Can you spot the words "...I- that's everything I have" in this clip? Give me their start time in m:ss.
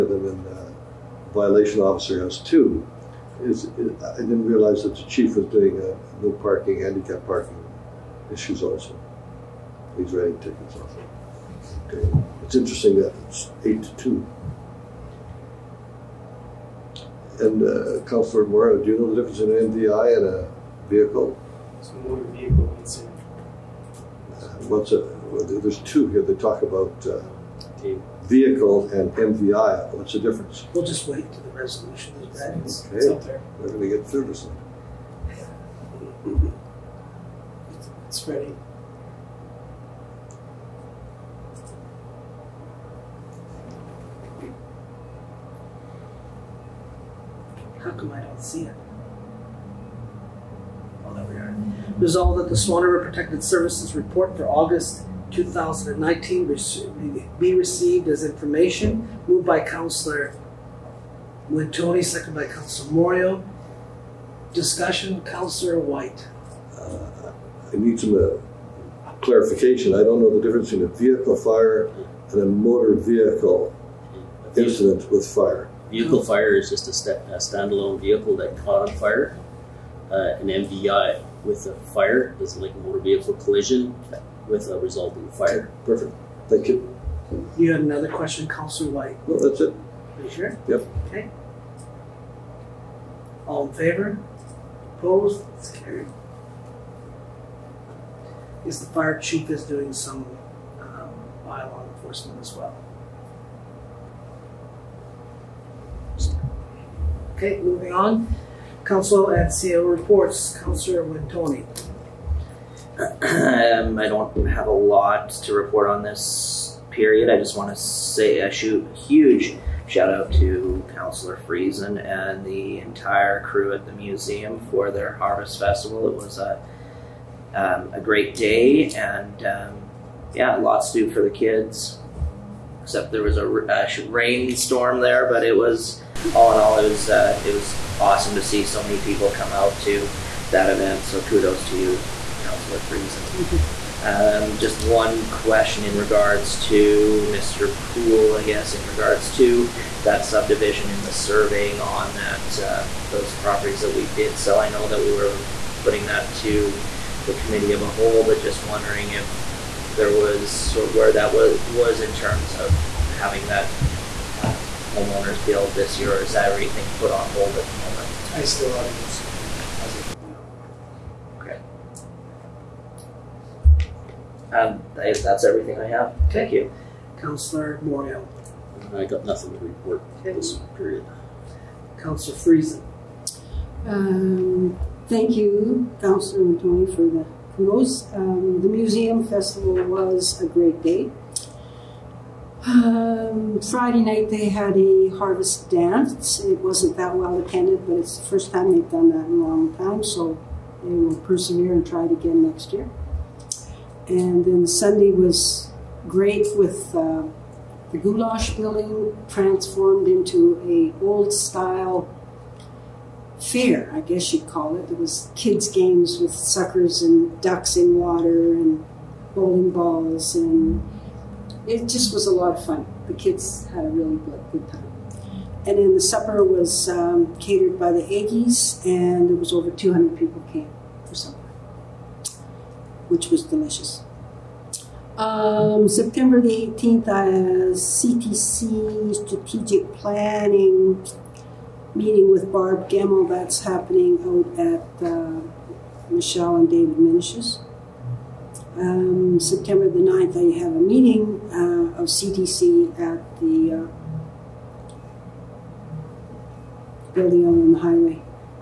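2:54.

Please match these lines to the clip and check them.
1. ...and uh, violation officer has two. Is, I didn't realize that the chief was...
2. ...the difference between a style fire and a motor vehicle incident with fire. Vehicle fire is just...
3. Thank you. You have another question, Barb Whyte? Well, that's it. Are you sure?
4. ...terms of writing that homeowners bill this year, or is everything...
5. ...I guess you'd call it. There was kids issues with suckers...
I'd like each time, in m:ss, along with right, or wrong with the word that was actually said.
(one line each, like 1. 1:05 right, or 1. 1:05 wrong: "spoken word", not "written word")
1. 0:00 right
2. 1:10 wrong: "vehicle", not "style"
3. 1:26 wrong: "Councilor", not "Barb"
4. 2:42 wrong: "having", not "writing"
5. 3:33 wrong: "games", not "issues".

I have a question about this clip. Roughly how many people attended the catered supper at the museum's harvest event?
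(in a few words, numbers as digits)
over 200.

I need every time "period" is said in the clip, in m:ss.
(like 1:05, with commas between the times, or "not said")
1:56, 3:00.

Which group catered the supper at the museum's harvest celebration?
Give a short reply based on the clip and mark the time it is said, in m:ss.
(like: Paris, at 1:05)
the Aggies, at 3:47.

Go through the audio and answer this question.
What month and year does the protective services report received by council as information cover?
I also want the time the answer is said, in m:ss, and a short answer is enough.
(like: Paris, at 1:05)
August 2019, at 0:54.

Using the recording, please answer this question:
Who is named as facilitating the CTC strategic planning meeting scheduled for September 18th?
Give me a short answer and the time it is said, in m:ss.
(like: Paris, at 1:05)
Barb Gemmel, at 4:02.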